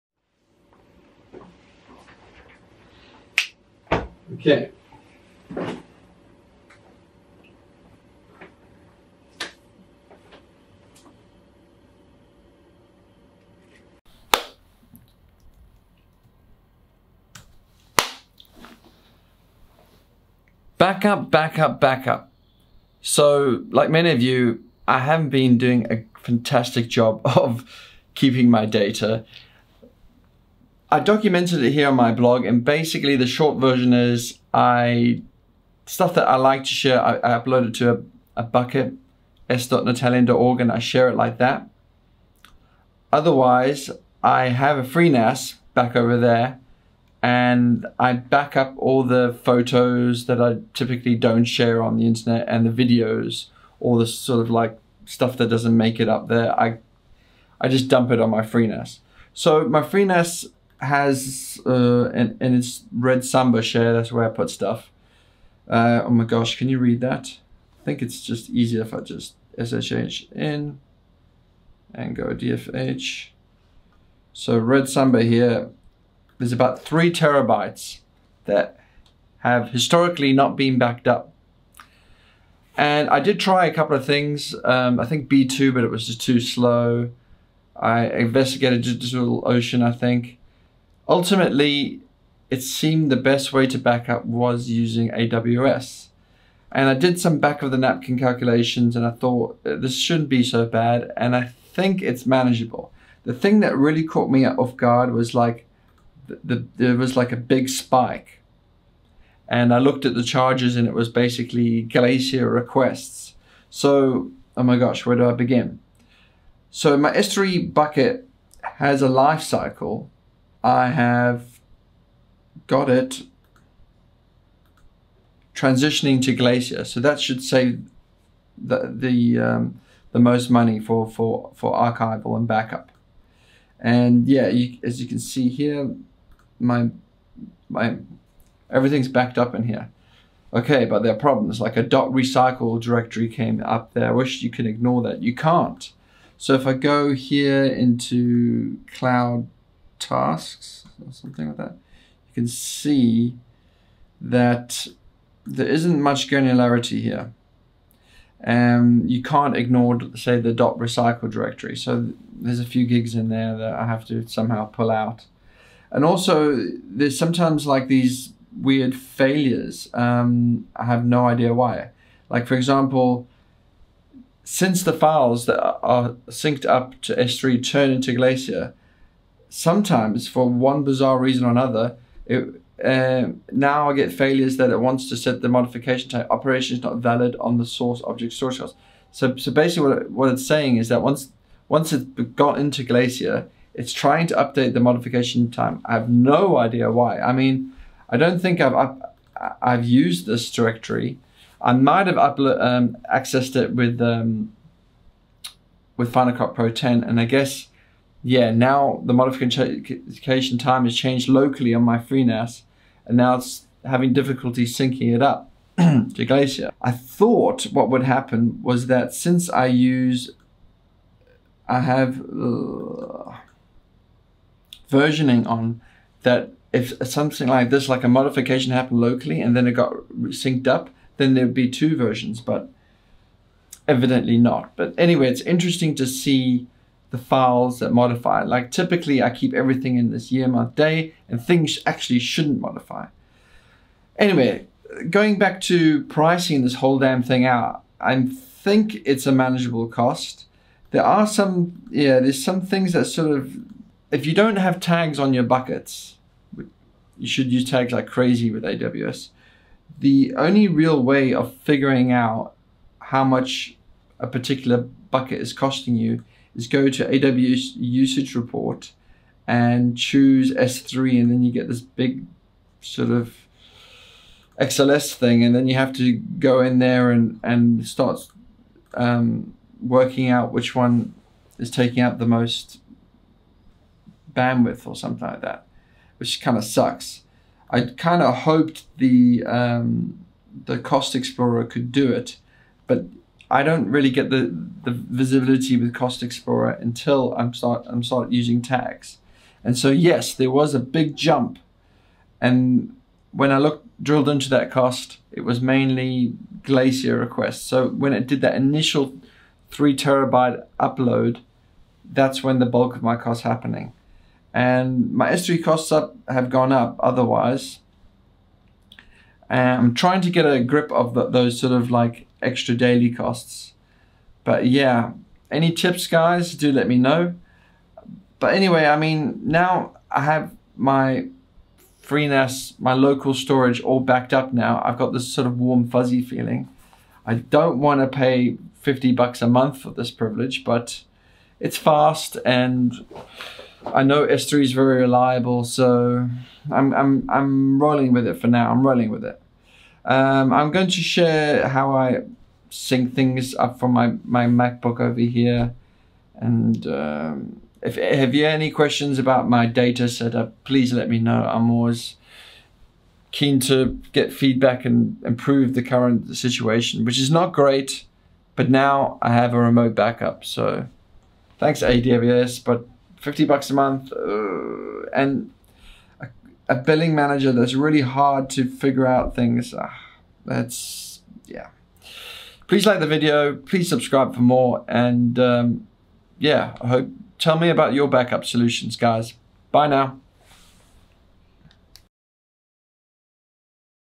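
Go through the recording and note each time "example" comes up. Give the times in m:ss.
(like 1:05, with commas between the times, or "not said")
2:52.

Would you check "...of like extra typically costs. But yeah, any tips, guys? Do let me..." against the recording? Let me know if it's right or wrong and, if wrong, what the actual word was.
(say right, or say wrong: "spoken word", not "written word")
wrong: "daily", not "typically".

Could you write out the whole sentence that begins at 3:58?
Like typically I keep everything in this year, month, day, and things actually shouldn't modify.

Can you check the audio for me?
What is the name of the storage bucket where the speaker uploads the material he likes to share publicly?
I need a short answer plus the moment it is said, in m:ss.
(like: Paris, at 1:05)
s.natalian.org, at 0:39.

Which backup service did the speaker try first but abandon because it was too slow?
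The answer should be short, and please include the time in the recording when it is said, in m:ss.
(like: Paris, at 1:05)
B2, at 1:25.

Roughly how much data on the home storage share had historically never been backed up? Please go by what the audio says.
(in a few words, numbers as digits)
3 terabytes.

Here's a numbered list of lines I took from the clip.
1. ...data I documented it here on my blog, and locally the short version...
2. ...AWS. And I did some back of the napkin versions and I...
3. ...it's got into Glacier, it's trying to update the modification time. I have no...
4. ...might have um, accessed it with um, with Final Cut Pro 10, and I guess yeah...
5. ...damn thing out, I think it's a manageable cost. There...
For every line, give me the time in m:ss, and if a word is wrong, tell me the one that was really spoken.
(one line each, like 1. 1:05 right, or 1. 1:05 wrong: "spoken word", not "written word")
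1. 0:28 wrong: "basically", not "locally"
2. 1:35 wrong: "calculations", not "versions"
3. 3:11 right
4. 3:21 right
5. 4:06 right.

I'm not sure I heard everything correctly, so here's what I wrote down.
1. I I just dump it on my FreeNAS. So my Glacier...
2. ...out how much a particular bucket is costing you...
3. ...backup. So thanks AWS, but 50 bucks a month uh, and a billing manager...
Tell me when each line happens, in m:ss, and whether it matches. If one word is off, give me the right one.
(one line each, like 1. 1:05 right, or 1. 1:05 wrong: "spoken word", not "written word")
1. 0:56 wrong: "FreeNAS", not "Glacier"
2. 4:22 right
3. 6:09 right.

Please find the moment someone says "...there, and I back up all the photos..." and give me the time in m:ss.
0:46.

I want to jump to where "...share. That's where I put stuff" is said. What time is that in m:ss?
1:03.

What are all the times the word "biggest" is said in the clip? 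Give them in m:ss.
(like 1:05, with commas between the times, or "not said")
not said.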